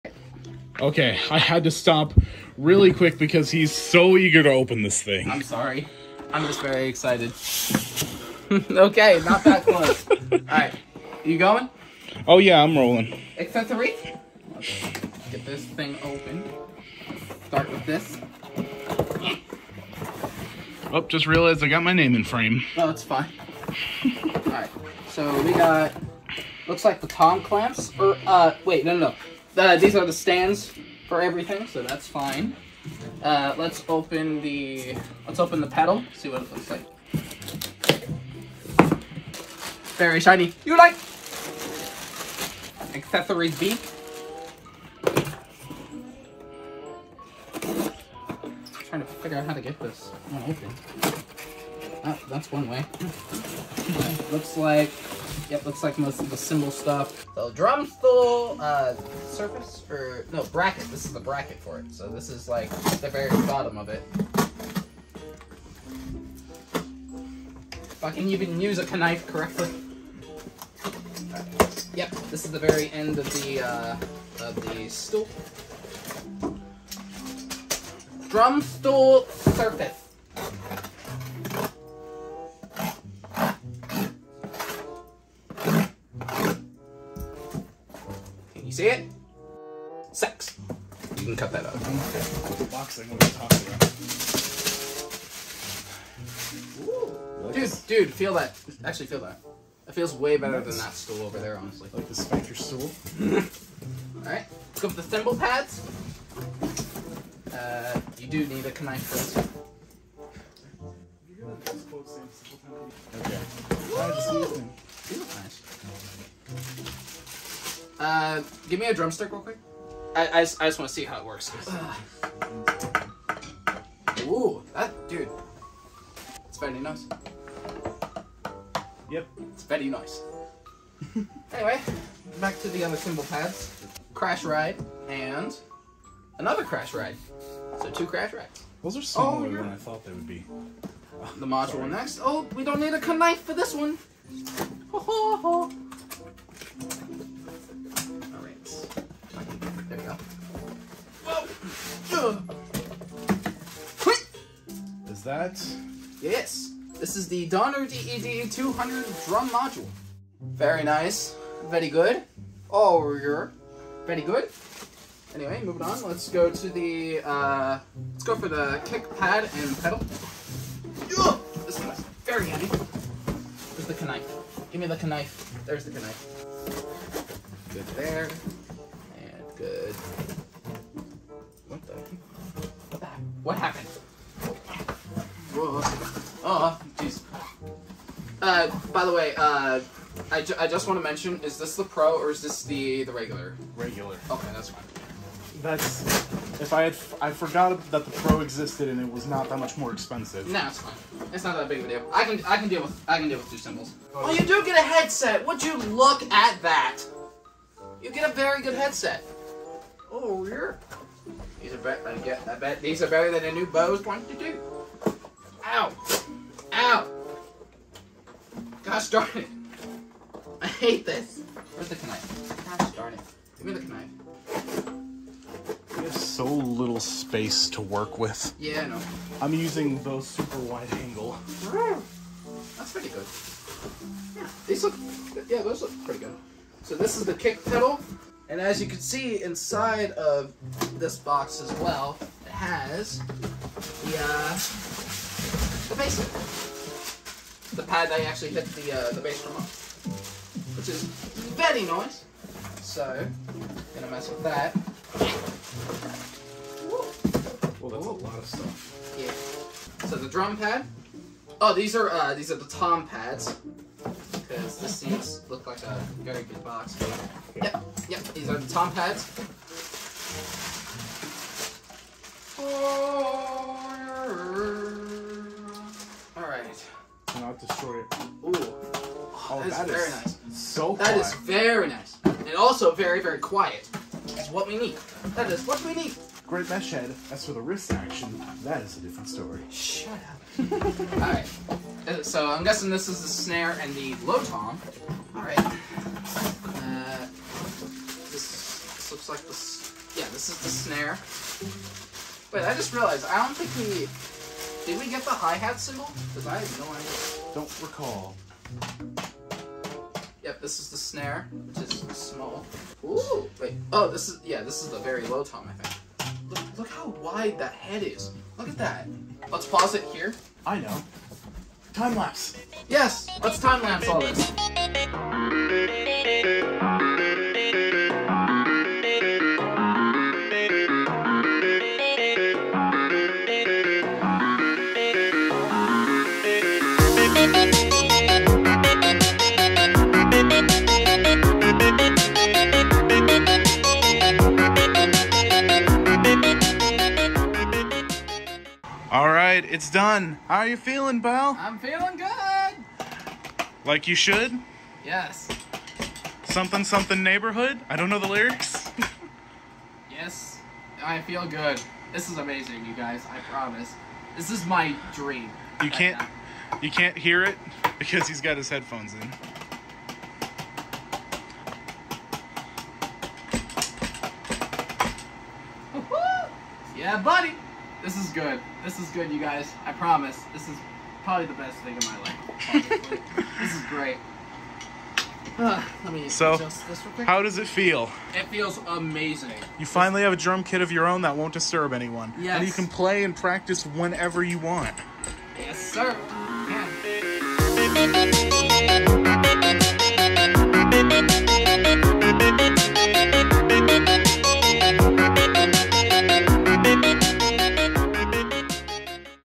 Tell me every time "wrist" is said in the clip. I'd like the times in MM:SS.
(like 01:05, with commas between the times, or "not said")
04:47.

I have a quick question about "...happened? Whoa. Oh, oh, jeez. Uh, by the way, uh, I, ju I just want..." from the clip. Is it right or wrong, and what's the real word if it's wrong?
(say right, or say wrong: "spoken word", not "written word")
right.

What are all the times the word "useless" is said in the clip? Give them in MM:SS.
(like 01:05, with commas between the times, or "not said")
not said.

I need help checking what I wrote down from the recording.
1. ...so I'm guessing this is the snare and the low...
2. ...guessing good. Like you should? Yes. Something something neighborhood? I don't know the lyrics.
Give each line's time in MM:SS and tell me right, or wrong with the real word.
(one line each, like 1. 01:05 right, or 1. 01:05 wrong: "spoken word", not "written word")
1. 04:52 right
2. 05:51 wrong: "feeling", not "guessing".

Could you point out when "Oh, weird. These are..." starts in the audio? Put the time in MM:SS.
03:30.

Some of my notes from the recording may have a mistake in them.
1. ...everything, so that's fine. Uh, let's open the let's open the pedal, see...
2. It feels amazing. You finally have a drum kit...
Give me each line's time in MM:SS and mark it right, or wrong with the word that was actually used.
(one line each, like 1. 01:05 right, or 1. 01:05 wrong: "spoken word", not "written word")
1. 00:31 right
2. 06:28 right.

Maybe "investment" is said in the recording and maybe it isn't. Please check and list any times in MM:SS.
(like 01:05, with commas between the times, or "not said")
not said.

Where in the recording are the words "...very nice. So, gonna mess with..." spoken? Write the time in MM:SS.
04:11.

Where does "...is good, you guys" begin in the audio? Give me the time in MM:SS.
06:18.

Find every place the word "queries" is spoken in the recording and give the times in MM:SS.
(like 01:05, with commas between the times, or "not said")
not said.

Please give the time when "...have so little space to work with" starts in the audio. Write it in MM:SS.
03:46.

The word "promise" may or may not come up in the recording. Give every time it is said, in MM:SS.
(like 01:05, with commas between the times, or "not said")
06:03, 06:19.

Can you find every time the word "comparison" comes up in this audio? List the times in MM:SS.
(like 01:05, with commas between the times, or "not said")
not said.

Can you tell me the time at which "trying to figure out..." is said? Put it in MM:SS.
00:48.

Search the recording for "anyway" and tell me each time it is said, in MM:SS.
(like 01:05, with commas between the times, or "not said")
02:11, 02:45.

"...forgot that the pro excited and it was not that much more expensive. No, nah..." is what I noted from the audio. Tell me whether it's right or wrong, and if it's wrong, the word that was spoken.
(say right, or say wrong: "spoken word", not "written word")
wrong: "existed", not "excited".